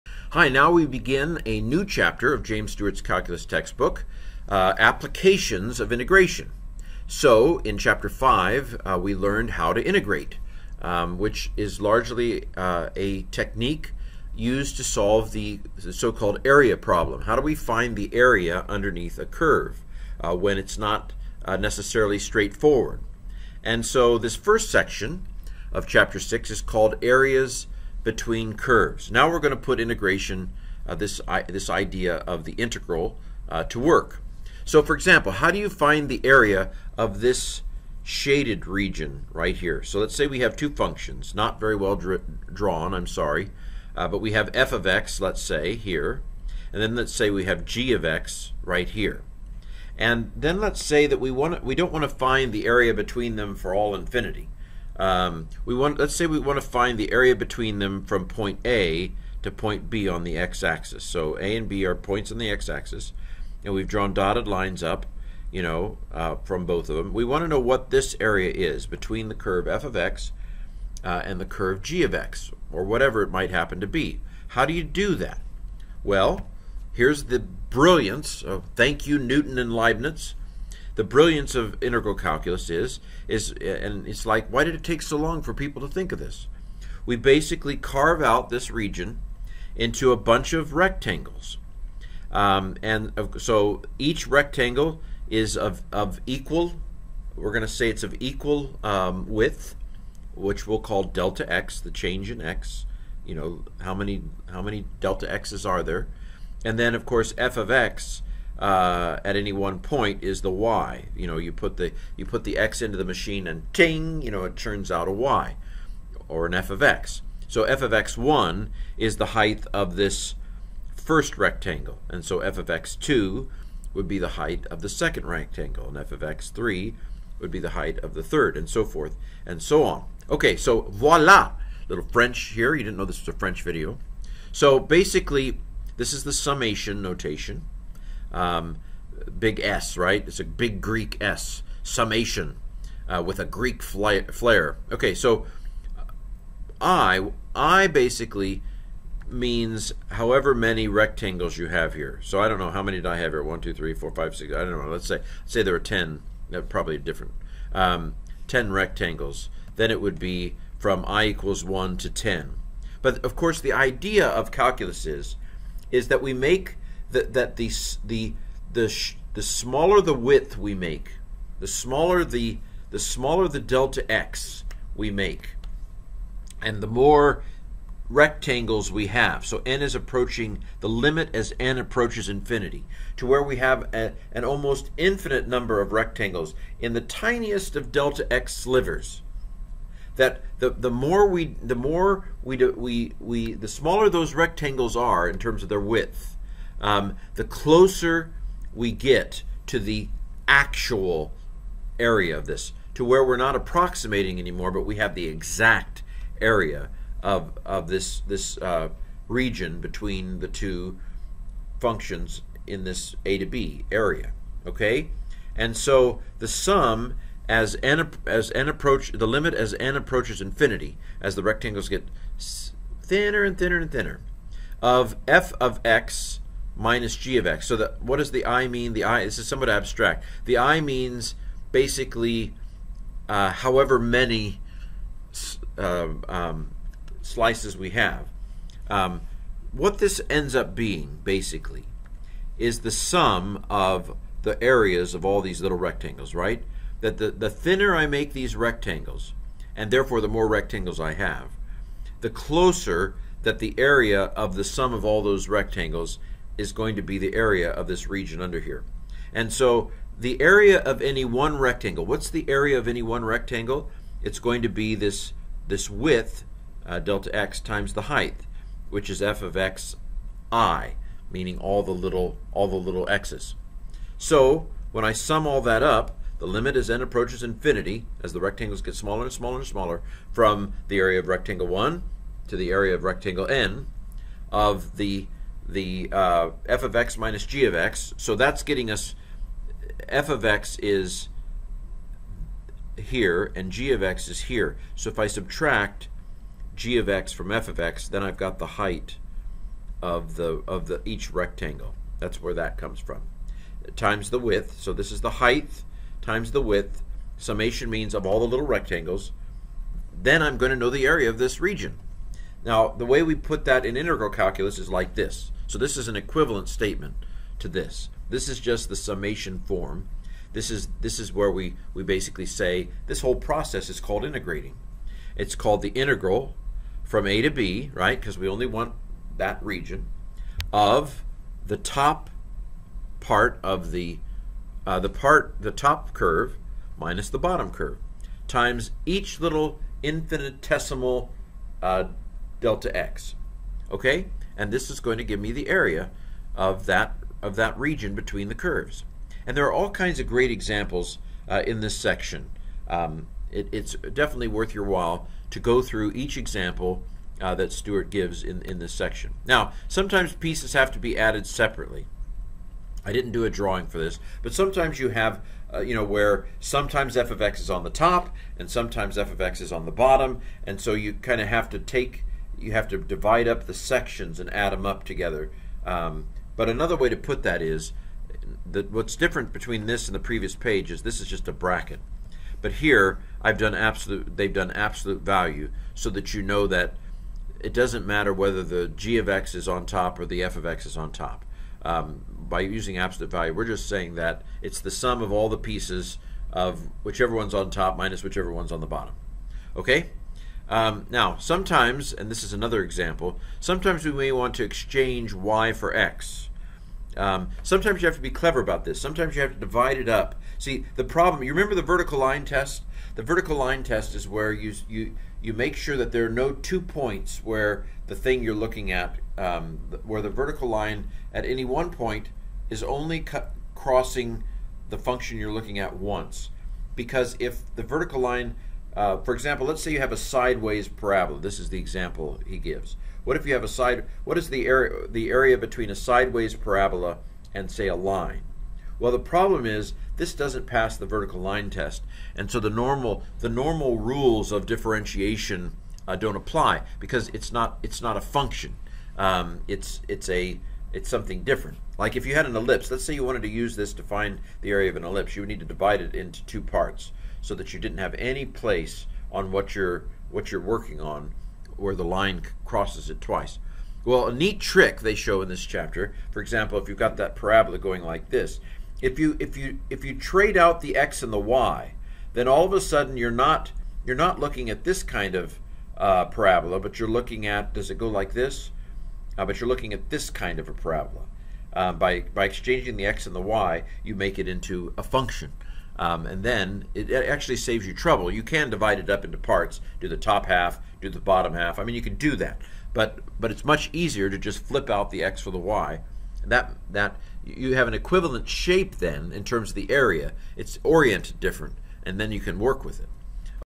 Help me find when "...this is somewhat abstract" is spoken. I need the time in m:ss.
3:49.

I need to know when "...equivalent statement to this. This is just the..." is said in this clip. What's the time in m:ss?
5:16.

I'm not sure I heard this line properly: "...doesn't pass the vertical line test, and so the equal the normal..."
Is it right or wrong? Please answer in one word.
wrong.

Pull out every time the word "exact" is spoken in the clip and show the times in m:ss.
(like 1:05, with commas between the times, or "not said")
3:25.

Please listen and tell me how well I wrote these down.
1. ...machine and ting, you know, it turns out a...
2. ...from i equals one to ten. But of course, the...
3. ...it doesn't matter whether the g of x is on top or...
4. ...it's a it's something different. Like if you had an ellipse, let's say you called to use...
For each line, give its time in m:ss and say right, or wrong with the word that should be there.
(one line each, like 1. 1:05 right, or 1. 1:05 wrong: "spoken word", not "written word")
1. 1:53 right
2. 2:40 right
3. 6:27 right
4. 7:30 wrong: "wanted", not "called".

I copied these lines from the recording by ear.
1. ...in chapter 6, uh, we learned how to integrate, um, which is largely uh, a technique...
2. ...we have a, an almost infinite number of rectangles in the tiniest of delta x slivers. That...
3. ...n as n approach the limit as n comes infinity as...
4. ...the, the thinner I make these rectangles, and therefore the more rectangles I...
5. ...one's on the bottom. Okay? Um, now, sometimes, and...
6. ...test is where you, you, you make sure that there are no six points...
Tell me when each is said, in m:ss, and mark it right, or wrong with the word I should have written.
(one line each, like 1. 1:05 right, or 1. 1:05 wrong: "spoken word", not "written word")
1. 0:07 wrong: "5", not "6"
2. 3:03 right
3. 3:37 wrong: "approaches", not "comes"
4. 4:07 right
5. 6:38 right
6. 6:53 wrong: "two", not "six".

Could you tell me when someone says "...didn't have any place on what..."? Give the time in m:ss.
7:37.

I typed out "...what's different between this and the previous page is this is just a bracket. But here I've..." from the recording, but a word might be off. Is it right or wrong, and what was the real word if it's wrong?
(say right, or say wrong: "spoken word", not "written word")
right.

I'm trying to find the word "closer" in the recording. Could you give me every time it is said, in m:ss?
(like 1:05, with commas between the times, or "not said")
3:17, 4:12.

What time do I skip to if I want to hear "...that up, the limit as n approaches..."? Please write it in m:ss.
4:35.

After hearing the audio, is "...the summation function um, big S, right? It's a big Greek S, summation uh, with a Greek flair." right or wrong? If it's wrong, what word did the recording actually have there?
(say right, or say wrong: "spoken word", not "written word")
wrong: "notation", not "function".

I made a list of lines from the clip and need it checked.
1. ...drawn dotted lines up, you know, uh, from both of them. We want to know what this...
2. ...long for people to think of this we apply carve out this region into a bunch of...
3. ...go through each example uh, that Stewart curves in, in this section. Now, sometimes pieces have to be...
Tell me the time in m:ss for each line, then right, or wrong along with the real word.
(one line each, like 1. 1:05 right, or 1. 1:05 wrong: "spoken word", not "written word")
1. 1:03 right
2. 1:25 wrong: "basically", not "apply"
3. 5:55 wrong: "gives", not "curves".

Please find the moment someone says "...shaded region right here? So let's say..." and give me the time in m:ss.
0:38.